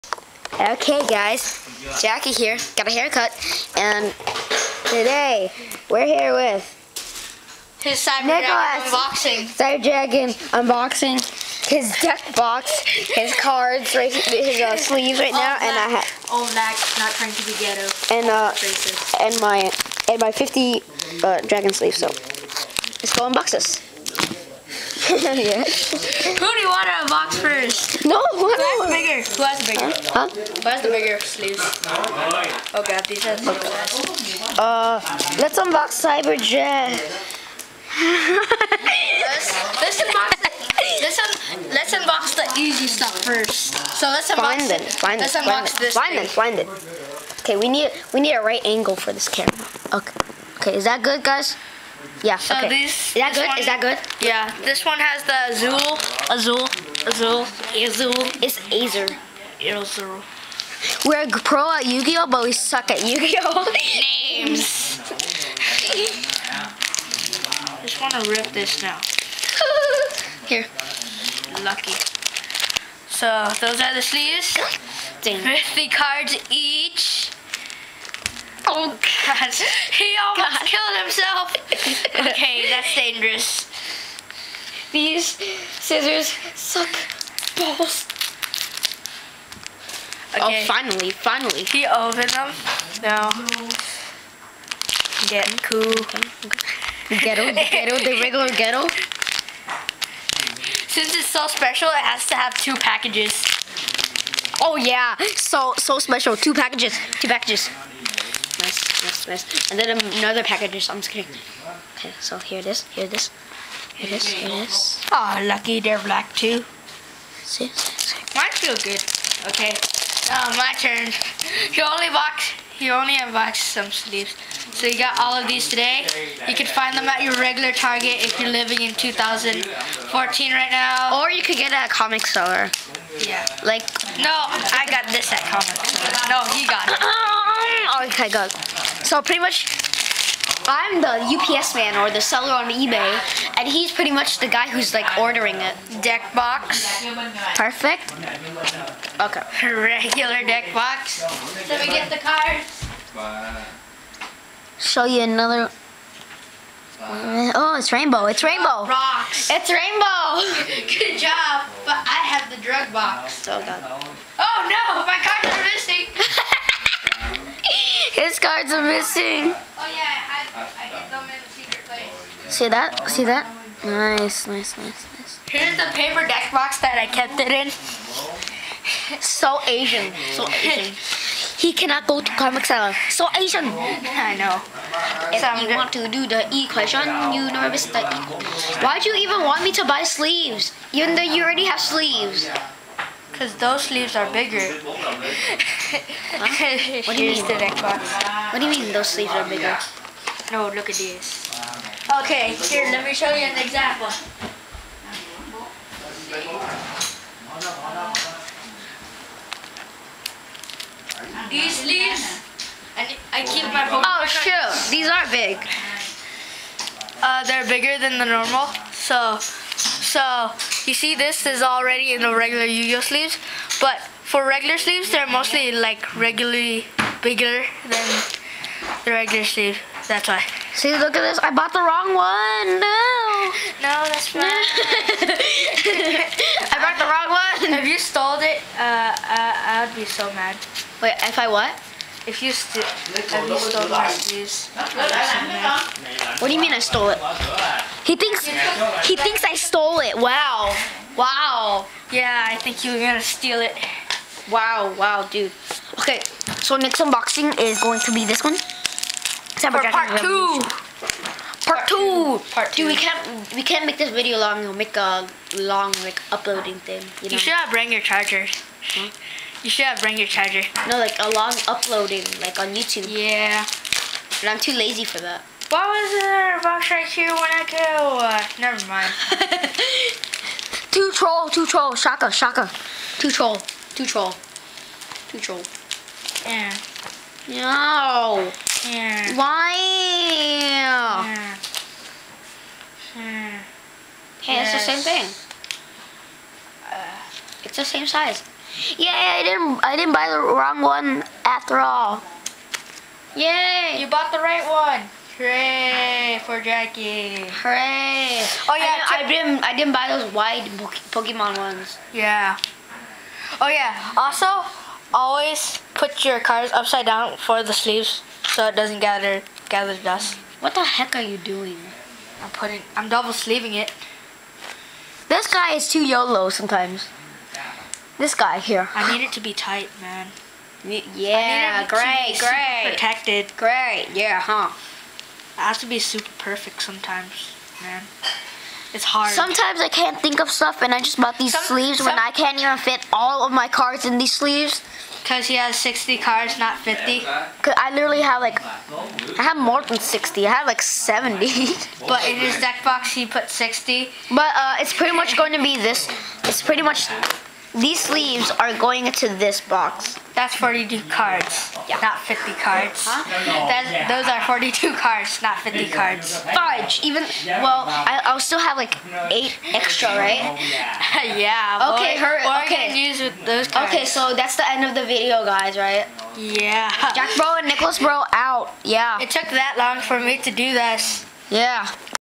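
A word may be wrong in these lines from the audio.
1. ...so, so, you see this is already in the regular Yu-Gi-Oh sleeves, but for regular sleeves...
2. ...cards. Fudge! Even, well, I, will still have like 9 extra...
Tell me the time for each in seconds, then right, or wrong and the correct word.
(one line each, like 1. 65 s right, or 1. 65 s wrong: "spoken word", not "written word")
1. 218 s right
2. 365 s wrong: "8", not "9".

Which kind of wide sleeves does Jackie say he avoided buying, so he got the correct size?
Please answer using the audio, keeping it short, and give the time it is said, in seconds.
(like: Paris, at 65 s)
Pokemon, at 310 s.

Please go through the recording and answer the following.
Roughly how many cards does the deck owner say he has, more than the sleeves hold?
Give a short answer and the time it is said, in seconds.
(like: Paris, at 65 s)
70, at 350 s.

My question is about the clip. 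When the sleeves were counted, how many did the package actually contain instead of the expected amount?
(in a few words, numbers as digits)
42.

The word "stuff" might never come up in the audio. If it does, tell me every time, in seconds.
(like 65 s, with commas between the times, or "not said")
42 s, 340 s.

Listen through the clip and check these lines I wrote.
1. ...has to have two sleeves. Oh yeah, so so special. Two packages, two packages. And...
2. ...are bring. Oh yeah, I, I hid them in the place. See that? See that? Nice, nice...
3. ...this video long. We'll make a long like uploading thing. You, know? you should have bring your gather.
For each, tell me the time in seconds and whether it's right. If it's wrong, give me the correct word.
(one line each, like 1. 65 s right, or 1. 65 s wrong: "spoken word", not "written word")
1. 102 s wrong: "packages", not "sleeves"
2. 168 s wrong: "missing", not "bring"
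3. 263 s wrong: "charger", not "gather".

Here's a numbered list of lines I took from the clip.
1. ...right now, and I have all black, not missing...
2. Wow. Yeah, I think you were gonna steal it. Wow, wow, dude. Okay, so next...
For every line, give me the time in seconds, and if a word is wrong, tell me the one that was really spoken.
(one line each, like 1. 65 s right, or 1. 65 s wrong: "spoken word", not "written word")
1. 15 s wrong: "trying", not "missing"
2. 251 s right.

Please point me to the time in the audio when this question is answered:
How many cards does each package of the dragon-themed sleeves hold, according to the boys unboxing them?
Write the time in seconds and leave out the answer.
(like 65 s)
75 s.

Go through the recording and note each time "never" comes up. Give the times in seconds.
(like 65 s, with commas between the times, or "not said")
187 s, 278 s.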